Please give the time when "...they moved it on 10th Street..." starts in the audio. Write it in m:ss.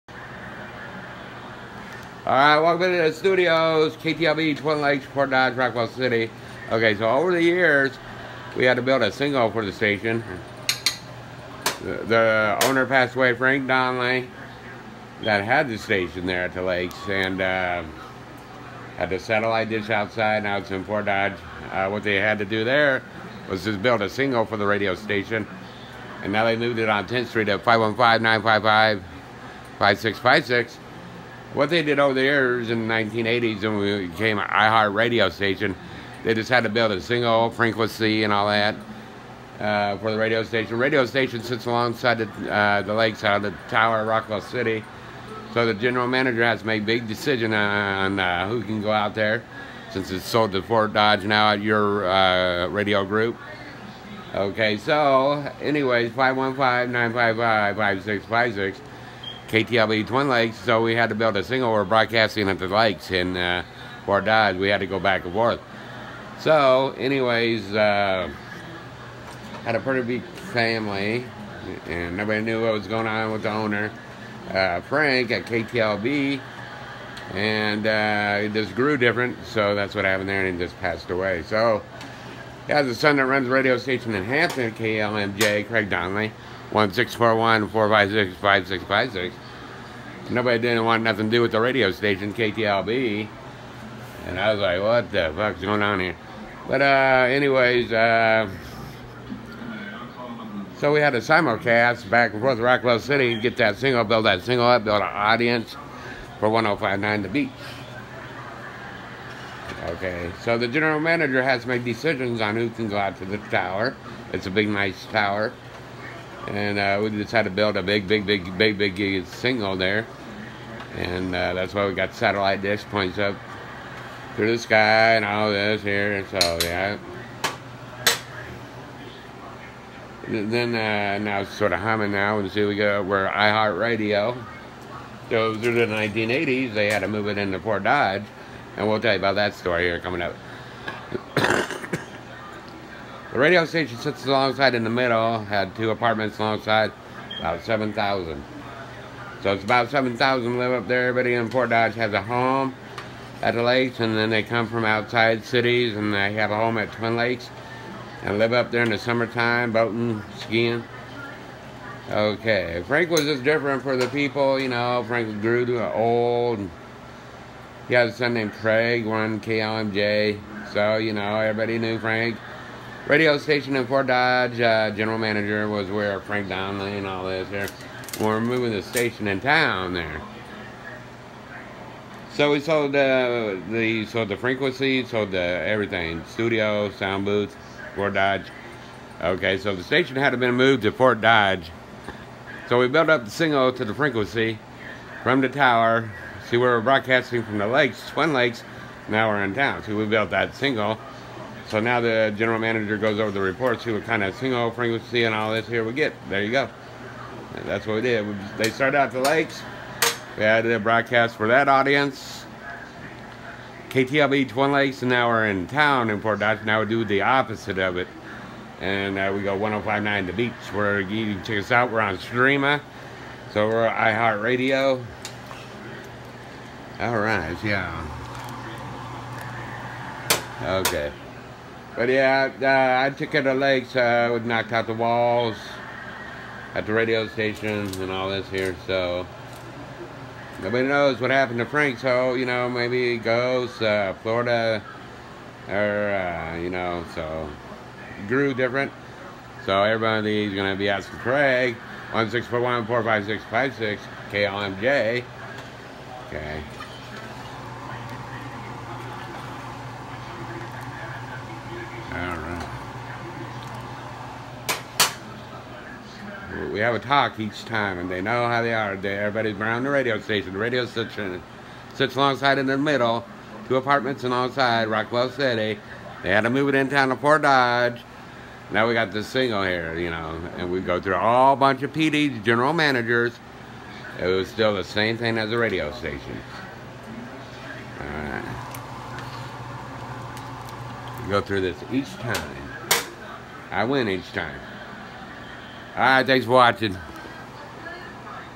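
0:26.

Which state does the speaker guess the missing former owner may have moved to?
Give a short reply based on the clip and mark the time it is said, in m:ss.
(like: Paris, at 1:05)
Florida, at 4:04.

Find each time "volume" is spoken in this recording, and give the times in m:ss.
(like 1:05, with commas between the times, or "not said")
not said.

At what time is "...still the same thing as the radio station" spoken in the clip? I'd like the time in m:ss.
4:44.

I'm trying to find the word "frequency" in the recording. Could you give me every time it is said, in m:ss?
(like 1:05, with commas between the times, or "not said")
0:37, 3:04, 3:13, 3:24.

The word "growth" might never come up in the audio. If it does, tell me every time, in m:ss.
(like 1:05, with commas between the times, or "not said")
not said.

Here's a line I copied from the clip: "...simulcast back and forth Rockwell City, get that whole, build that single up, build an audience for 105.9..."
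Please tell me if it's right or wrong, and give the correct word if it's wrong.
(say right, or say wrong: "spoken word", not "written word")
wrong: "single", not "whole".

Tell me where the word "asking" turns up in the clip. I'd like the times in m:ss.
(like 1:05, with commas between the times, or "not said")
4:10.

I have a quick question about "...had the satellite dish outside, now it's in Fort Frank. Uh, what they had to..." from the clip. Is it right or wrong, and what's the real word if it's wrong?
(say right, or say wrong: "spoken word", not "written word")
wrong: "Dodge", not "Frank".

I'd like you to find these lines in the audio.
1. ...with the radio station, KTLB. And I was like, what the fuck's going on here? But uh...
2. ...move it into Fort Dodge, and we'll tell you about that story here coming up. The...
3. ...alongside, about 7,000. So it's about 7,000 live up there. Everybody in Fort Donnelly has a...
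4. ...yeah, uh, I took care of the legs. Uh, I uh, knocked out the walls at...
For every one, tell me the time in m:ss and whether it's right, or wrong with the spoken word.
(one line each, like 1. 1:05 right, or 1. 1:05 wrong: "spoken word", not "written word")
1. 1:31 right
2. 2:17 right
3. 2:26 wrong: "Dodge", not "Donnelly"
4. 3:52 right.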